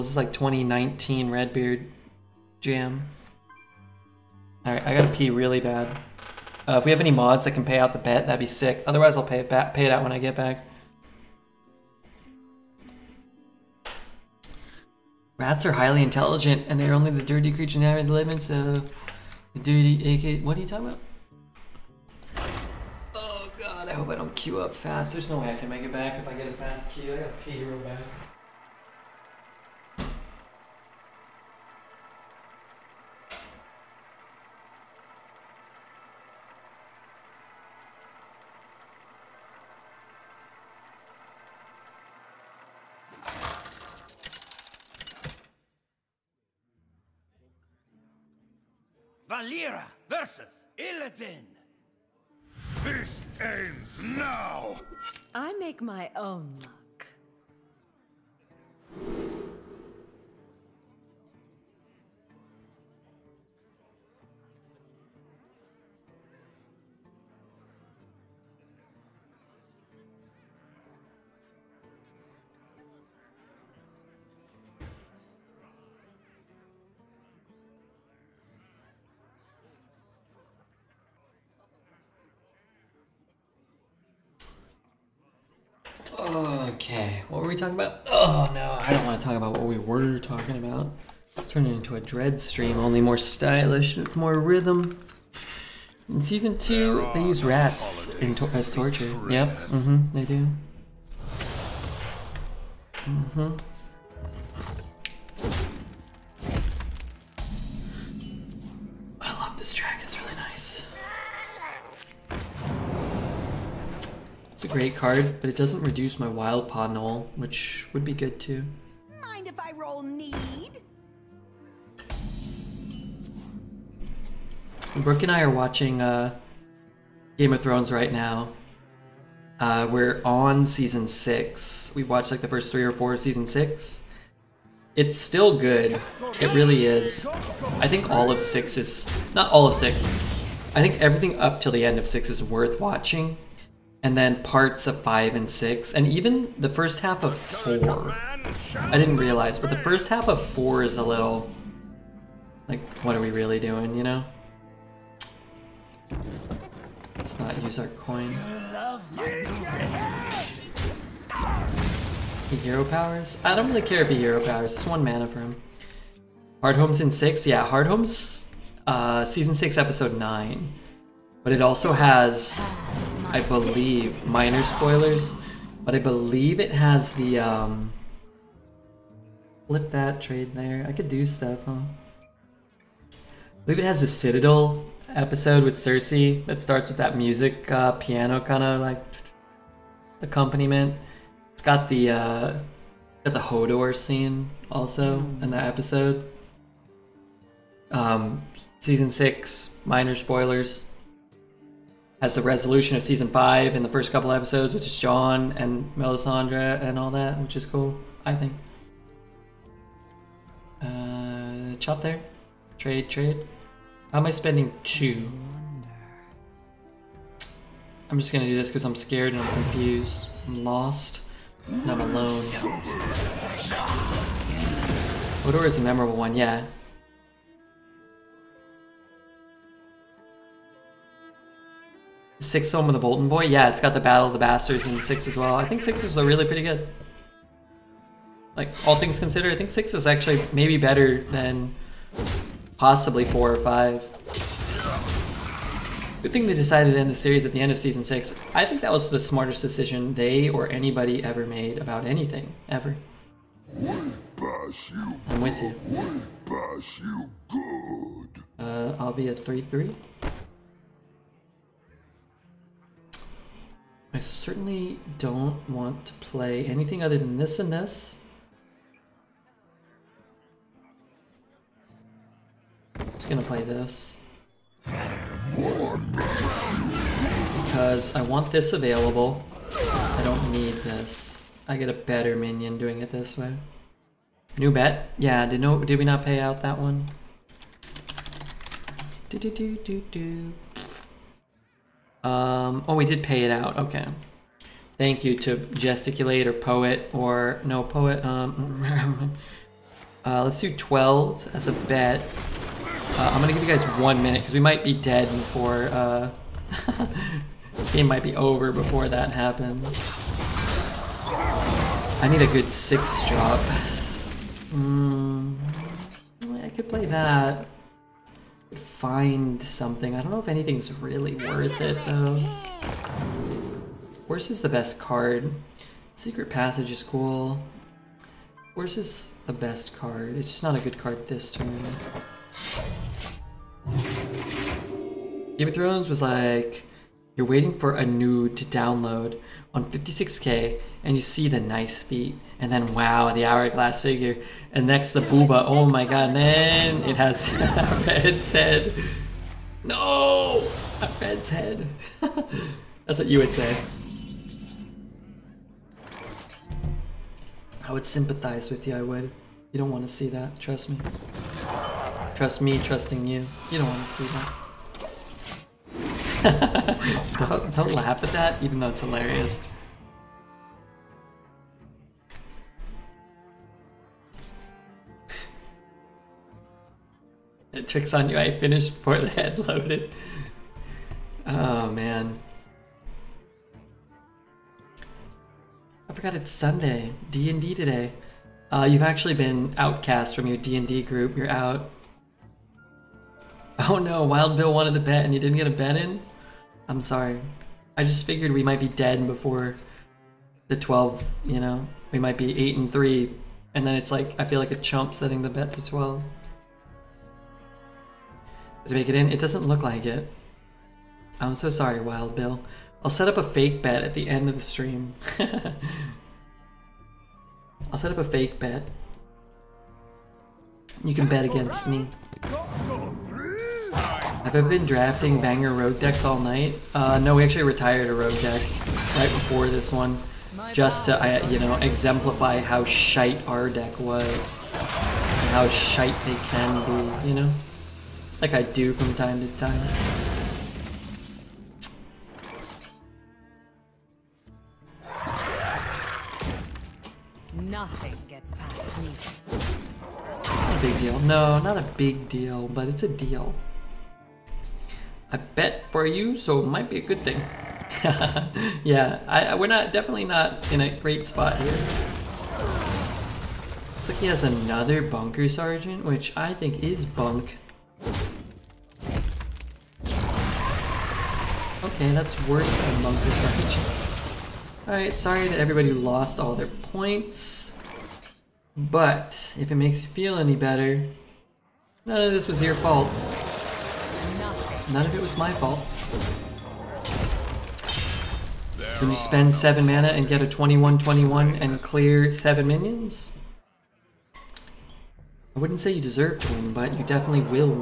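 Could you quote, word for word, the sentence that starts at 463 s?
It's like he has another bunker sergeant, which I think is bunk.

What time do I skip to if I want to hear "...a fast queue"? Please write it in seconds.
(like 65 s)
26 s.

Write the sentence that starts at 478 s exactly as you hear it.
But, if it makes you feel any better, none of this was your fault.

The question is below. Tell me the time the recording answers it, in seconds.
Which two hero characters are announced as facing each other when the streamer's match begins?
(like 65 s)
49 s.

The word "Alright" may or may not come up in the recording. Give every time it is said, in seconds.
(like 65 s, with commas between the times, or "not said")
4 s, 474 s.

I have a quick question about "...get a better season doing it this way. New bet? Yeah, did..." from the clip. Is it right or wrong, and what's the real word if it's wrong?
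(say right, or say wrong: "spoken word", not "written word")
wrong: "minion", not "season".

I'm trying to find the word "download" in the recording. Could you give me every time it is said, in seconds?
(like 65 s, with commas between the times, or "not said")
338 s.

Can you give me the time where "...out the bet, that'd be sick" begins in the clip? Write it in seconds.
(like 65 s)
7 s.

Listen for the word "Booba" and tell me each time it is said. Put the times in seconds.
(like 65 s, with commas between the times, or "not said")
345 s.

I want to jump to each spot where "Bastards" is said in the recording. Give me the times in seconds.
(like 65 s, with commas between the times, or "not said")
234 s.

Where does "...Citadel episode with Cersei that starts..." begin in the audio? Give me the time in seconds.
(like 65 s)
184 s.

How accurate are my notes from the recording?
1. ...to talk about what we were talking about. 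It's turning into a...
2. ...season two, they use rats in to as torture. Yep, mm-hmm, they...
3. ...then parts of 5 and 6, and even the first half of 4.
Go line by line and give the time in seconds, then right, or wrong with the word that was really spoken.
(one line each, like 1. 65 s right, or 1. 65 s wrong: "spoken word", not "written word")
1. 89 s right
2. 96 s right
3. 144 s right.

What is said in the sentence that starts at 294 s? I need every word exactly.
Thank you to gesticulate or poet or no poet.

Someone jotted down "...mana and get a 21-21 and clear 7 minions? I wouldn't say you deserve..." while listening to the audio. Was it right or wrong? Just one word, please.
right.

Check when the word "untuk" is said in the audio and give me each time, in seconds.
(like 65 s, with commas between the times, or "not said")
not said.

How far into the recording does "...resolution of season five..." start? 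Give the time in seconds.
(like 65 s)
202 s.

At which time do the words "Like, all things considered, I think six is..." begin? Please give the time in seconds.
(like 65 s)
238 s.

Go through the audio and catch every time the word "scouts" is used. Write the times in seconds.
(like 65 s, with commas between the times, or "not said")
not said.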